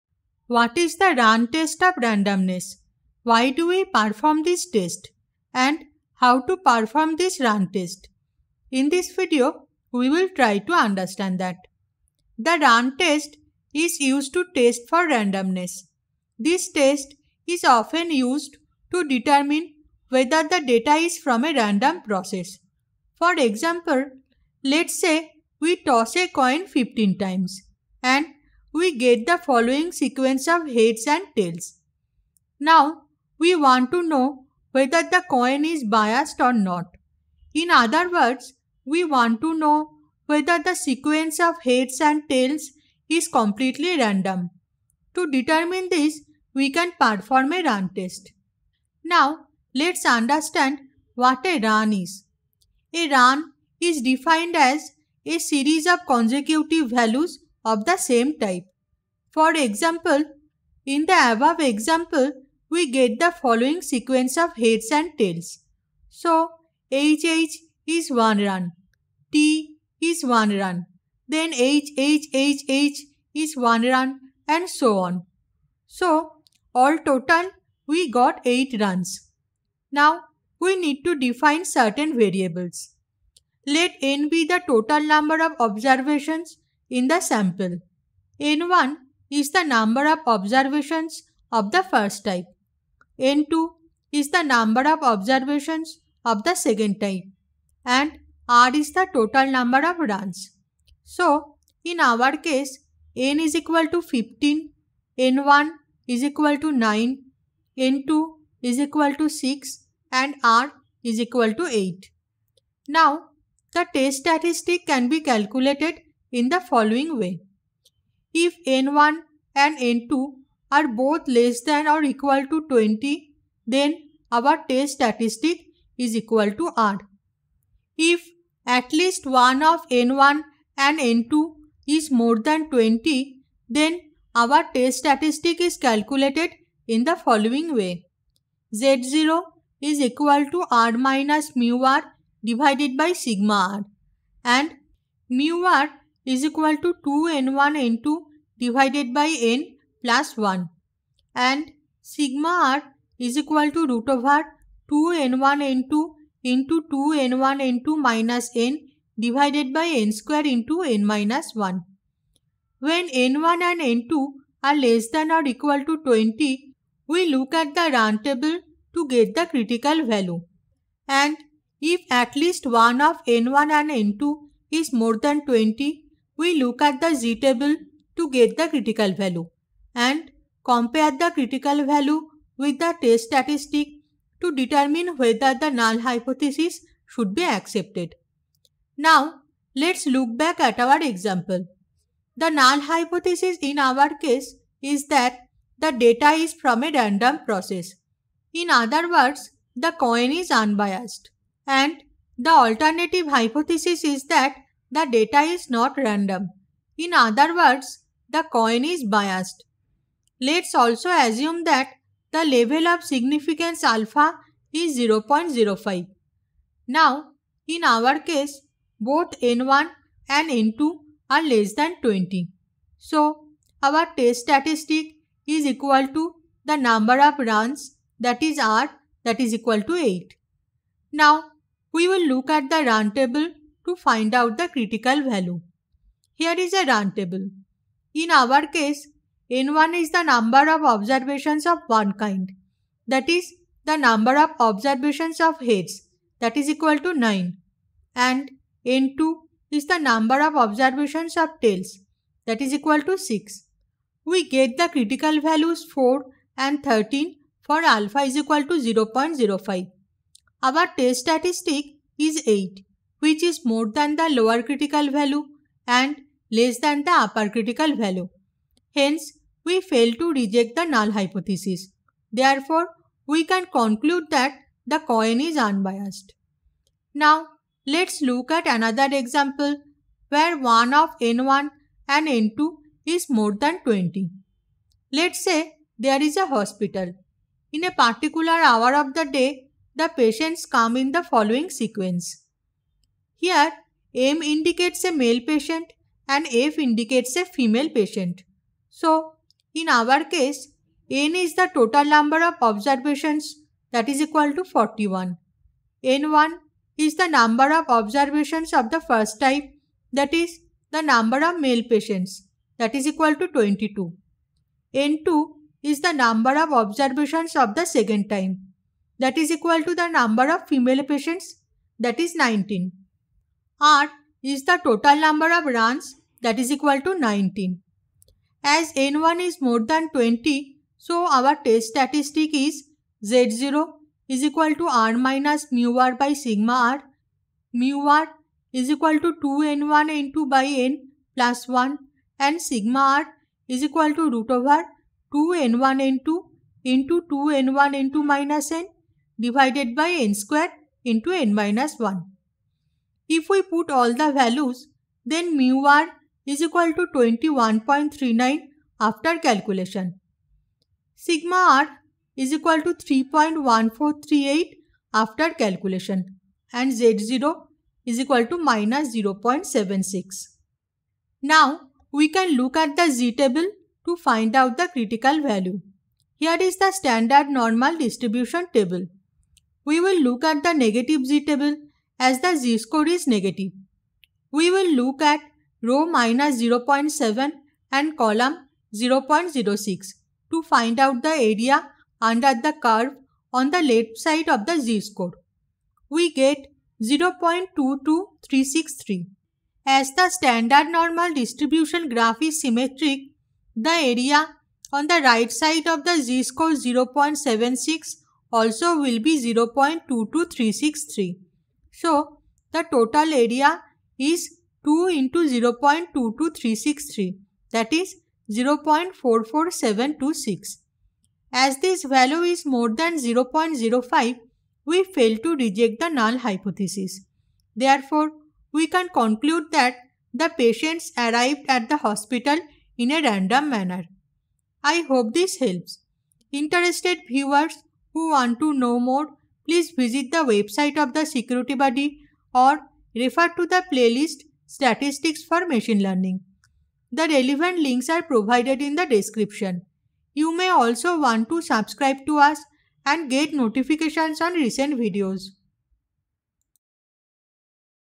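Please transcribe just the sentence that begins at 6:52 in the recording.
So the total area is 2 into 0 0.22363 that is 0 0.44726.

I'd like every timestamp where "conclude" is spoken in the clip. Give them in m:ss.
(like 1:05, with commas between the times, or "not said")
4:33, 7:09.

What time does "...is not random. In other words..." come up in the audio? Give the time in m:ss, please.
3:25.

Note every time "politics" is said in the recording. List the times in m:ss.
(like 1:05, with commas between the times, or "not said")
not said.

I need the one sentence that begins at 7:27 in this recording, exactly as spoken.
The relevant links are provided in the description.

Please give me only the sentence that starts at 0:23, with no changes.
For example, let's say we toss a coin 15 times and get the following sequence of heads and tails.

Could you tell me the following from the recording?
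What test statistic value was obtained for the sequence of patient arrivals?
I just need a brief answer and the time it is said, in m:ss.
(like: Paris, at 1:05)
-0.76, at 6:08.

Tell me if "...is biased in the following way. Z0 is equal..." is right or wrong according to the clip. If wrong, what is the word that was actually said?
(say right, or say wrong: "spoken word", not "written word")
wrong: "calculated", not "biased".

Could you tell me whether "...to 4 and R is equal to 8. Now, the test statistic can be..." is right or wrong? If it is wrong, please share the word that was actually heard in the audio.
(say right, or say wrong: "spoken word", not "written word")
wrong: "6", not "4".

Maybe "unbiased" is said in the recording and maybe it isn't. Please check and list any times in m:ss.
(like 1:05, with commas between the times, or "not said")
3:20, 4:35.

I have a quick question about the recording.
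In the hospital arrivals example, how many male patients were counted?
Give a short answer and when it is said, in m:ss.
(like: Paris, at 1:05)
22, at 5:13.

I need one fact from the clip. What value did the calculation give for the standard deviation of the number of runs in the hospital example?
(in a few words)
3.1438.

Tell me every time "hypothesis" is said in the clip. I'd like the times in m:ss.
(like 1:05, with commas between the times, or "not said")
3:06, 3:12, 3:23, 4:31, 7:06.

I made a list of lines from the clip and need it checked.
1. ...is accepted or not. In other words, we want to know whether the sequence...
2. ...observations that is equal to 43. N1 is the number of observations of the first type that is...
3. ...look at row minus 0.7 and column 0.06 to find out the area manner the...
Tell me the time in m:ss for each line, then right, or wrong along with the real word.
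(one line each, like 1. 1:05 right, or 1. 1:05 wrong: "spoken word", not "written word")
1. 0:35 wrong: "biased", not "accepted"
2. 5:02 wrong: "41", not "43"
3. 6:24 wrong: "under", not "manner".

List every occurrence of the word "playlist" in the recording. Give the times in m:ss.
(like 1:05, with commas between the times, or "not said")
7:23.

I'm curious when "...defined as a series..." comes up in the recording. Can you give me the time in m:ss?
0:54.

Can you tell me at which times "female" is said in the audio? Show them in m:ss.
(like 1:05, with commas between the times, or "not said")
4:57, 5:20.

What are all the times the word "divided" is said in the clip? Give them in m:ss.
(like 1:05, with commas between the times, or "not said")
2:22, 2:28, 2:39, 5:49.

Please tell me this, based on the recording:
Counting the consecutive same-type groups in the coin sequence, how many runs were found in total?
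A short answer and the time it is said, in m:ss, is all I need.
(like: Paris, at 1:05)
8, at 1:18.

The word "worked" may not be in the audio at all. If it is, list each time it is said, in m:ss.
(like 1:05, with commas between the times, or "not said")
not said.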